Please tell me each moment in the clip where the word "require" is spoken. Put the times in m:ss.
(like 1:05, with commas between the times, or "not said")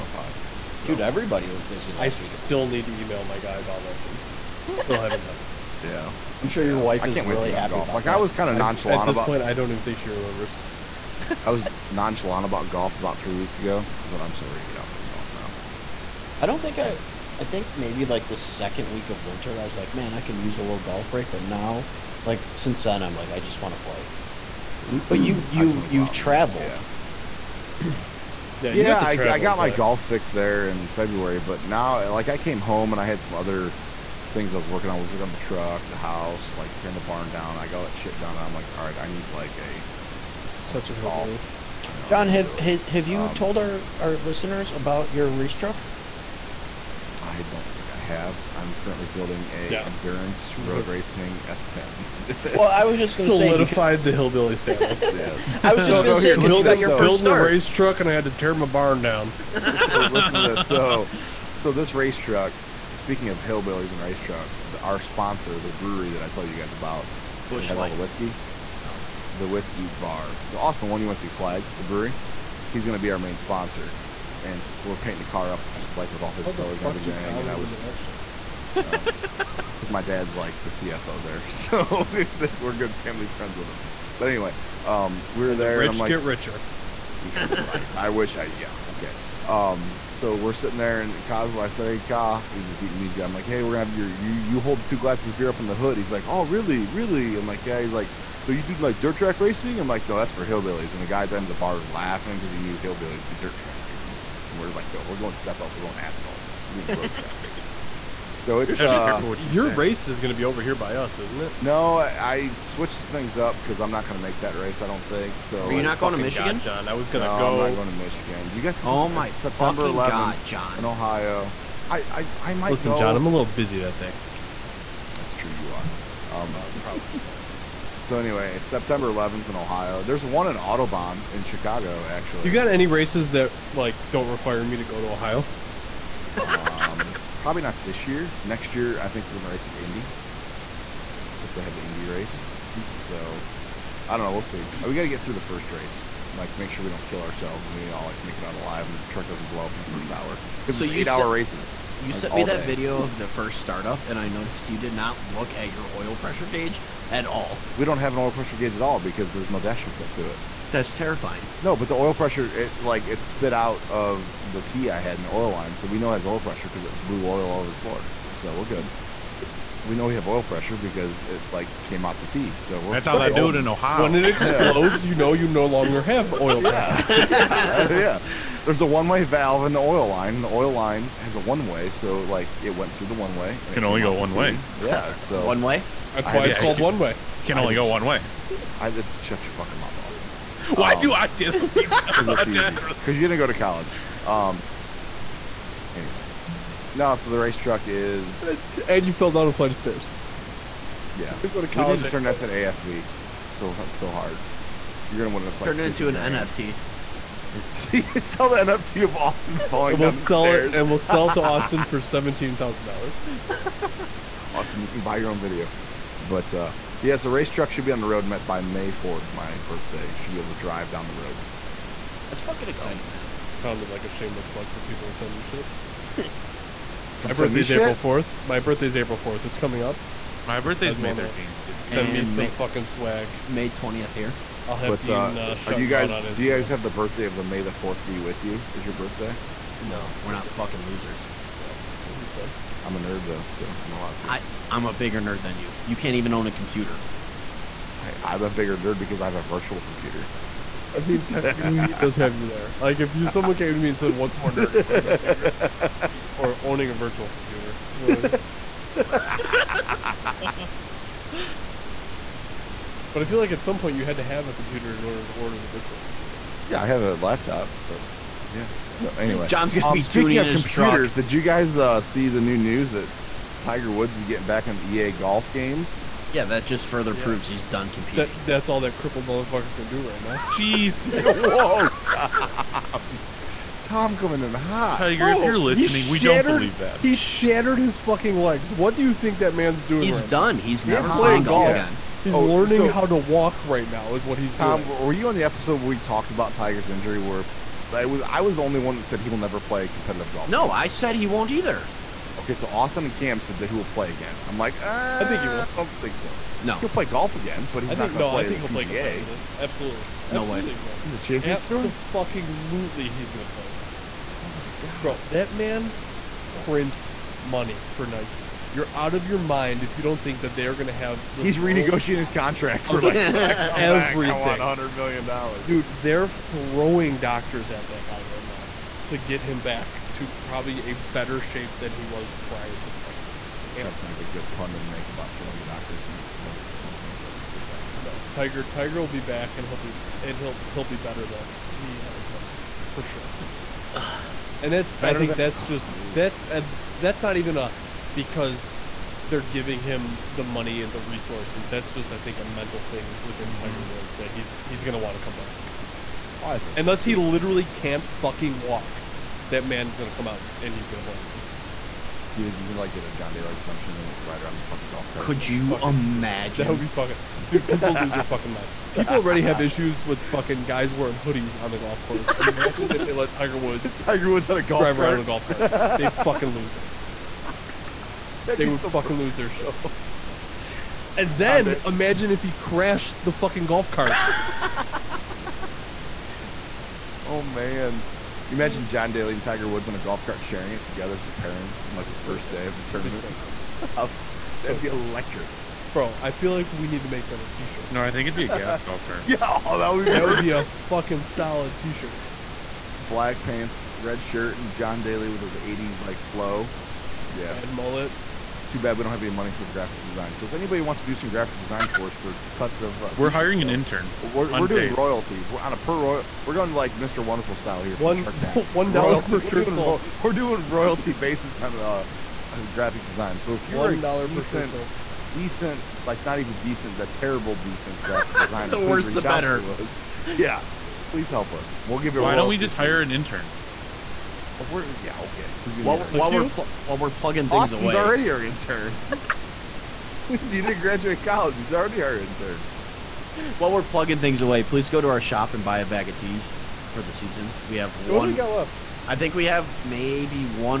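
2:14.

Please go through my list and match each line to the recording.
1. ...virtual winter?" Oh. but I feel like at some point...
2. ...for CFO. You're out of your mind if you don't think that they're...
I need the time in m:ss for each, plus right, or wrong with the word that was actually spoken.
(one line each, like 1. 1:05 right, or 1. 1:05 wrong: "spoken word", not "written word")
1. 4:16 wrong: "computer", not "winter"
2. 5:17 wrong: "Nike", not "CFO".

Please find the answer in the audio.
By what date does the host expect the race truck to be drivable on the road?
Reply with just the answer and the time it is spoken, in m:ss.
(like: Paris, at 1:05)
May 4th, at 3:38.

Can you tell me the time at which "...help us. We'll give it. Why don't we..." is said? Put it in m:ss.
7:11.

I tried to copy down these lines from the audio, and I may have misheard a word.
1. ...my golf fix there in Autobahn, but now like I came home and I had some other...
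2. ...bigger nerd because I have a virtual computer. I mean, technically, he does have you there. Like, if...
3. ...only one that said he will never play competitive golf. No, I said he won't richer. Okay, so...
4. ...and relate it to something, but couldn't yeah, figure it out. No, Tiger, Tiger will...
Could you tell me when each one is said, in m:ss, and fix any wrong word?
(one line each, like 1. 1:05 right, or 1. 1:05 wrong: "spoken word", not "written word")
1. 0:29 wrong: "February", not "Autobahn"
2. 4:08 right
3. 4:58 wrong: "either", not "richer"
4. 5:36 right.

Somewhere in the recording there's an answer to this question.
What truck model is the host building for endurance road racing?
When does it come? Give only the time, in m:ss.
0:51.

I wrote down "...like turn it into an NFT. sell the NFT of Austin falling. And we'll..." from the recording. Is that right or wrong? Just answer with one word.
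right.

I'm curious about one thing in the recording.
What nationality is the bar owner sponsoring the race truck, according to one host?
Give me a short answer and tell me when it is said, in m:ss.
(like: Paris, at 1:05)
Vietnamese, at 1:32.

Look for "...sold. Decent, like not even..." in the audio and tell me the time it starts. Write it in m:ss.
7:04.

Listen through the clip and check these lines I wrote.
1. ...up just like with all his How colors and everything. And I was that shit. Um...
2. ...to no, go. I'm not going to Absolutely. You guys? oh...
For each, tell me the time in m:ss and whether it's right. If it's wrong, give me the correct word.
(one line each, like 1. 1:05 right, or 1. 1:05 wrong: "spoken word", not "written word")
1. 1:15 right
2. 1:57 wrong: "Michigan", not "Absolutely".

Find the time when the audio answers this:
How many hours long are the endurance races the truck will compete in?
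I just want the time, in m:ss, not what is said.
2:30.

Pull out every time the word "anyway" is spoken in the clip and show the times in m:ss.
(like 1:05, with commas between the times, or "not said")
1:24, 2:08, 3:15, 4:29.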